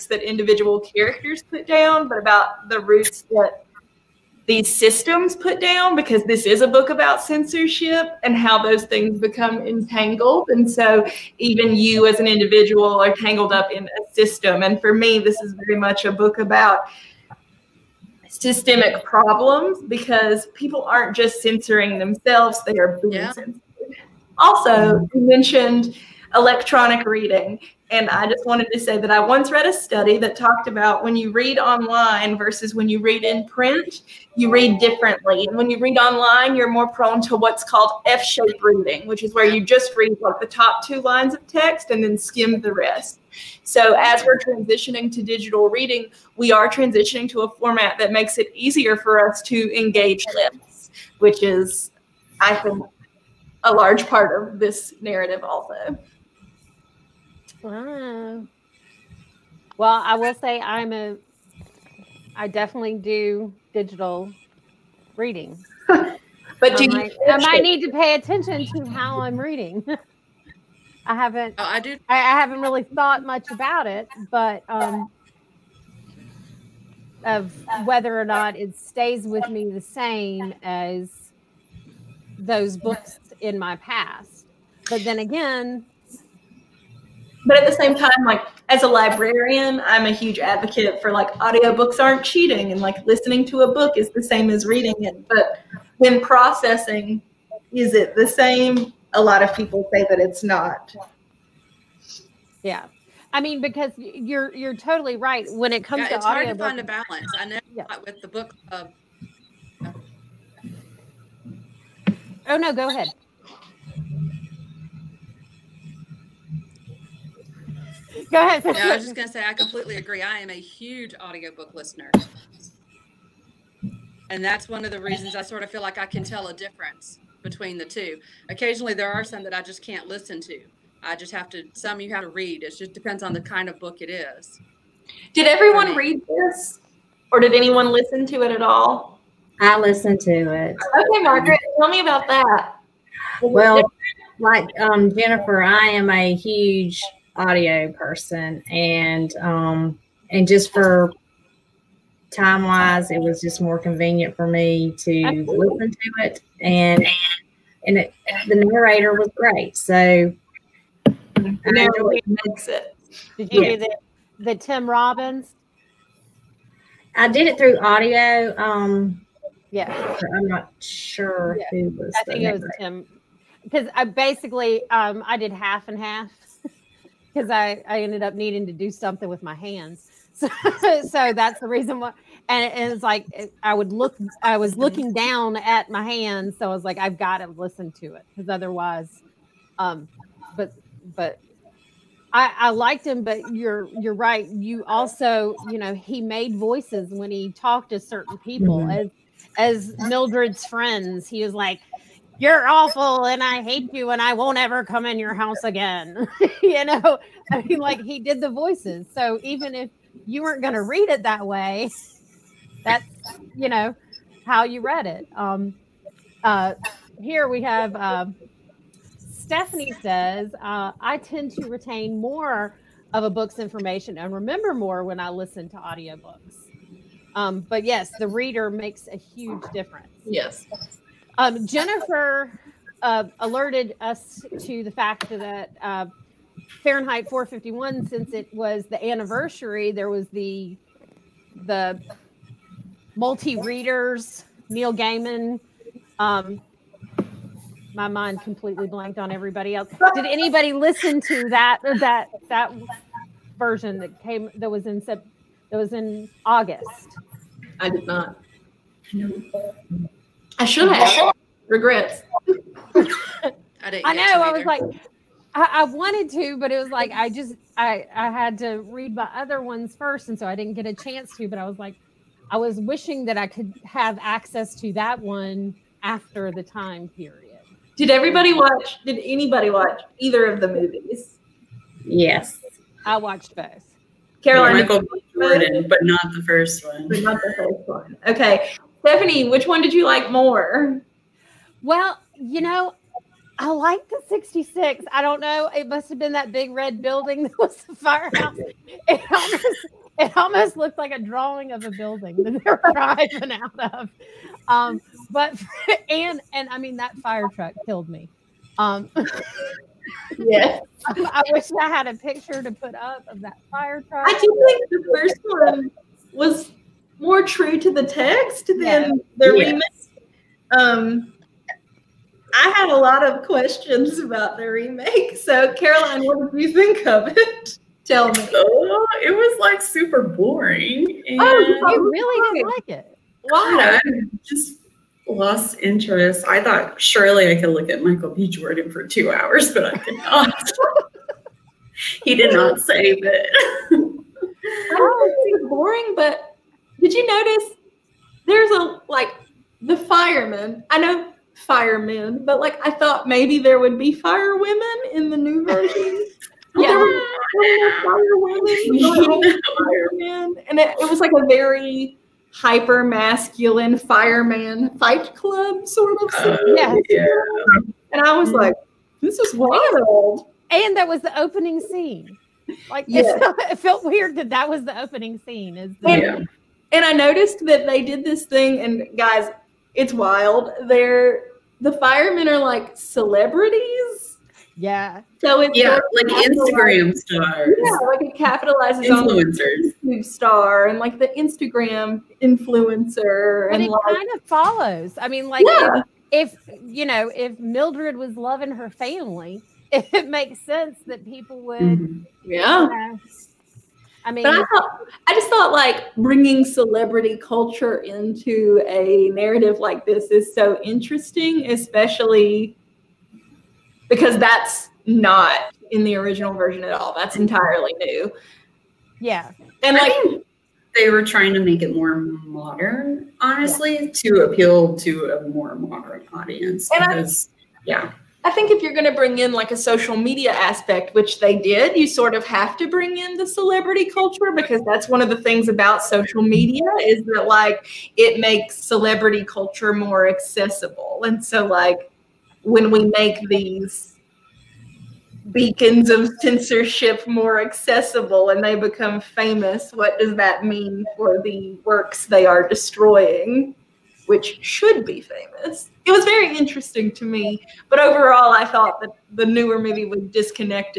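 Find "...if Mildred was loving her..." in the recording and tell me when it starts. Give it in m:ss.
6:37.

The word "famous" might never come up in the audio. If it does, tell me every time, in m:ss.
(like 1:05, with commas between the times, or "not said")
7:29, 7:35.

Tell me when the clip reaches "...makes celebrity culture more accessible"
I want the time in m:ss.
7:18.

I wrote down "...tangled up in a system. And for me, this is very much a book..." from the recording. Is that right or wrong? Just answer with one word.
right.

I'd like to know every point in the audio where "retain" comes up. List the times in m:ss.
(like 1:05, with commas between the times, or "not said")
3:41.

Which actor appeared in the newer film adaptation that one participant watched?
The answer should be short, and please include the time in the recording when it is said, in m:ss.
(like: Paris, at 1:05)
Michael B. 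Jordan, at 4:44.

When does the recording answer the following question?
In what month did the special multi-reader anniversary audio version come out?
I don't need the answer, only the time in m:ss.
4:16.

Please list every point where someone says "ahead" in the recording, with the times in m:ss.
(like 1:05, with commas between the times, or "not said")
1:52, 1:58.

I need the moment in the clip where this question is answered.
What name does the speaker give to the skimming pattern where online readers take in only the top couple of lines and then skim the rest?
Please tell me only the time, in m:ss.
0:38.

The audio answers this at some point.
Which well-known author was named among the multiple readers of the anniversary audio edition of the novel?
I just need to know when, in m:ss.
4:04.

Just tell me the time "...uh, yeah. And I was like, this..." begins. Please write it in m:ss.
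6:06.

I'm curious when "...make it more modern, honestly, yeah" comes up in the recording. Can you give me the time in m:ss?
7:01.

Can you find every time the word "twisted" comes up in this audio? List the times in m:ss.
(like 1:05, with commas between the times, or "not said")
not said.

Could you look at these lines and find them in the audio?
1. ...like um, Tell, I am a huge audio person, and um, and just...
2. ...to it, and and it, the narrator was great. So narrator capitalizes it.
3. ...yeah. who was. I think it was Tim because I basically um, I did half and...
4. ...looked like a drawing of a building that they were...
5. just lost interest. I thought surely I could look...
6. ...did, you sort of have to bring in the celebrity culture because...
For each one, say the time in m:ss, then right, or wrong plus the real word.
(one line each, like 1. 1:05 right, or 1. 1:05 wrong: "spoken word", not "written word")
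1. 2:24 wrong: "Jennifer", not "Tell"
2. 2:35 wrong: "makes", not "capitalizes"
3. 2:51 right
4. 5:00 right
5. 5:34 right
6. 7:11 right.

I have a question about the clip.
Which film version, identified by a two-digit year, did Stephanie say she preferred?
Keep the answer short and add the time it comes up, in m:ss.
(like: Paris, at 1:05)
66, at 4:54.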